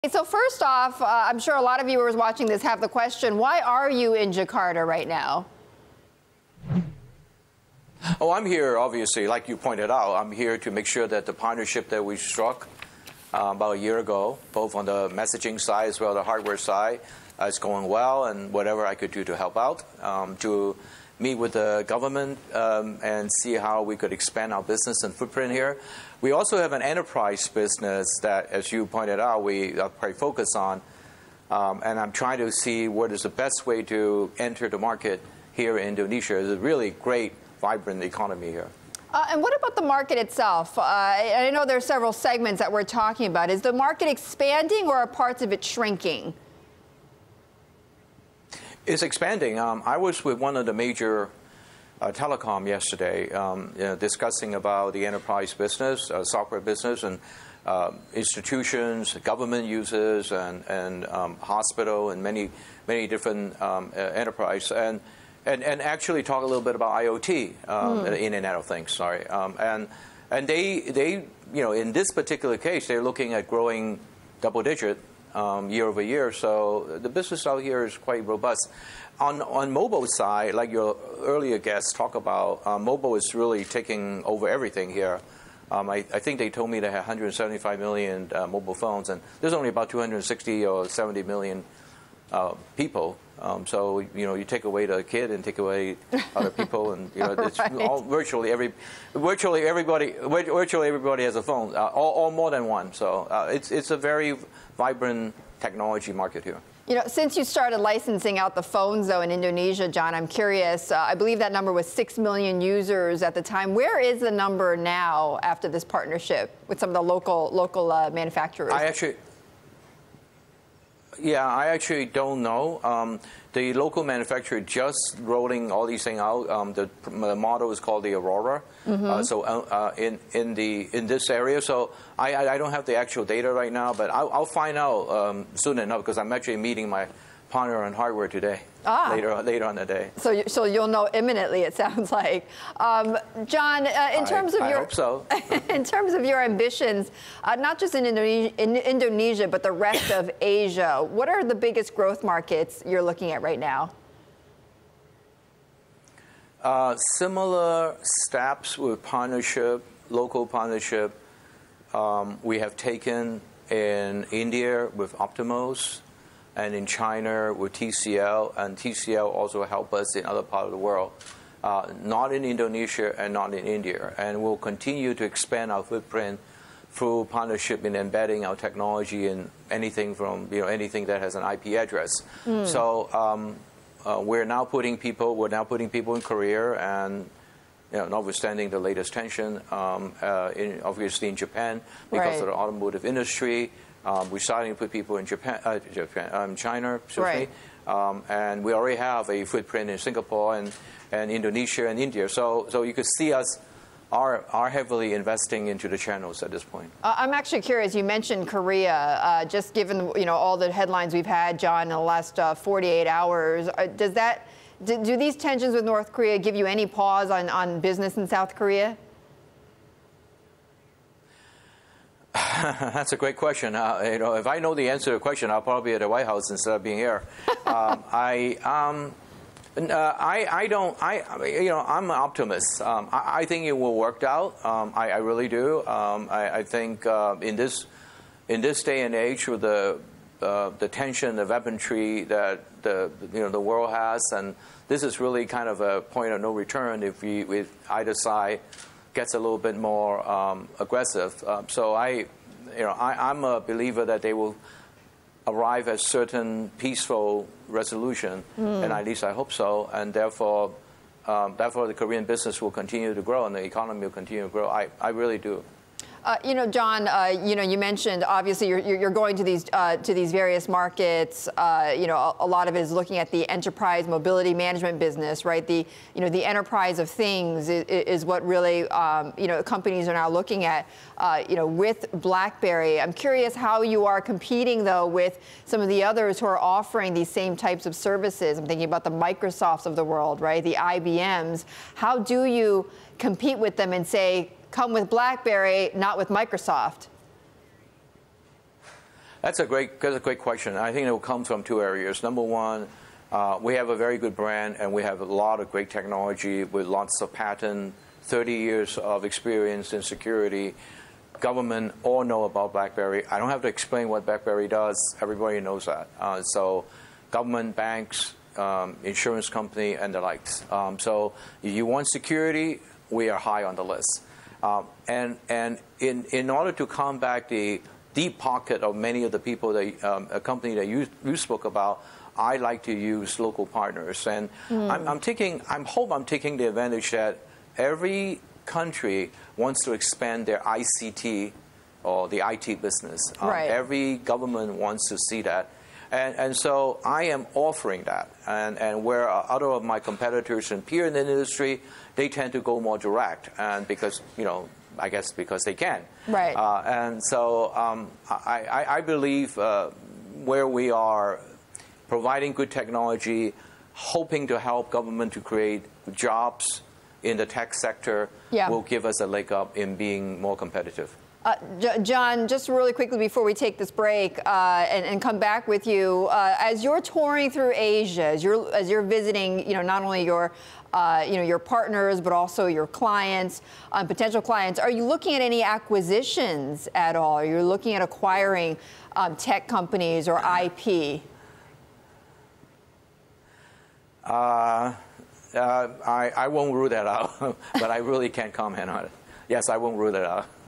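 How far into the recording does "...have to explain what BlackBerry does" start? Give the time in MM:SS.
05:13.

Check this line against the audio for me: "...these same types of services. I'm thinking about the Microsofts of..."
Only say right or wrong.
right.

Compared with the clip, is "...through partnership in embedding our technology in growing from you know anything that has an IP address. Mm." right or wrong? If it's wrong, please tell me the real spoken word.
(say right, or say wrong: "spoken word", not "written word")
wrong: "anything", not "growing".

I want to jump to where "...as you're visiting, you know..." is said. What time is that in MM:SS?
06:18.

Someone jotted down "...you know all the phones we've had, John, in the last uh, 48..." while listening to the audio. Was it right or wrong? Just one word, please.
wrong.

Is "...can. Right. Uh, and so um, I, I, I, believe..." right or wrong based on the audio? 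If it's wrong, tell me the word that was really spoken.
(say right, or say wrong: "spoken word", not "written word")
right.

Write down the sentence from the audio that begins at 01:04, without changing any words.
And, and, and actually talk a little bit about IoT, um, mm.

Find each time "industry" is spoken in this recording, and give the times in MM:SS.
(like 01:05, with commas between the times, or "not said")
03:13, 05:51.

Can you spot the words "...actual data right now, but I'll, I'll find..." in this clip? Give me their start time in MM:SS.
02:12.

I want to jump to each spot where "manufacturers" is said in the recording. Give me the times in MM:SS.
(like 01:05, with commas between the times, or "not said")
01:58, 02:04.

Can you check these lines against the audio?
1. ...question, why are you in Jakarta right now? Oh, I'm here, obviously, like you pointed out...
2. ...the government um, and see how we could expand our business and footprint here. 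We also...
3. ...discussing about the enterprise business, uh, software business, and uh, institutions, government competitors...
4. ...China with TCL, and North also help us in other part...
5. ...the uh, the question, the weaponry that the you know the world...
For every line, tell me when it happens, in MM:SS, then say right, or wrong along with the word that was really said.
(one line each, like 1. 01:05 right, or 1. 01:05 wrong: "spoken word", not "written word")
1. 00:02 right
2. 00:21 right
3. 00:53 wrong: "users", not "competitors"
4. 02:46 wrong: "TCL", not "North"
5. 03:59 wrong: "tension", not "question".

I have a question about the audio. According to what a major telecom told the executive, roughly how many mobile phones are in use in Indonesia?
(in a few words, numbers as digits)
175 million.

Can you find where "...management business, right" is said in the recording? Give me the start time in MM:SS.
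04:34.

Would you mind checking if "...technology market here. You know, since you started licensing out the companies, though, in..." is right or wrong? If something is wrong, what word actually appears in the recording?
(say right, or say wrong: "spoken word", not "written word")
wrong: "phones", not "companies".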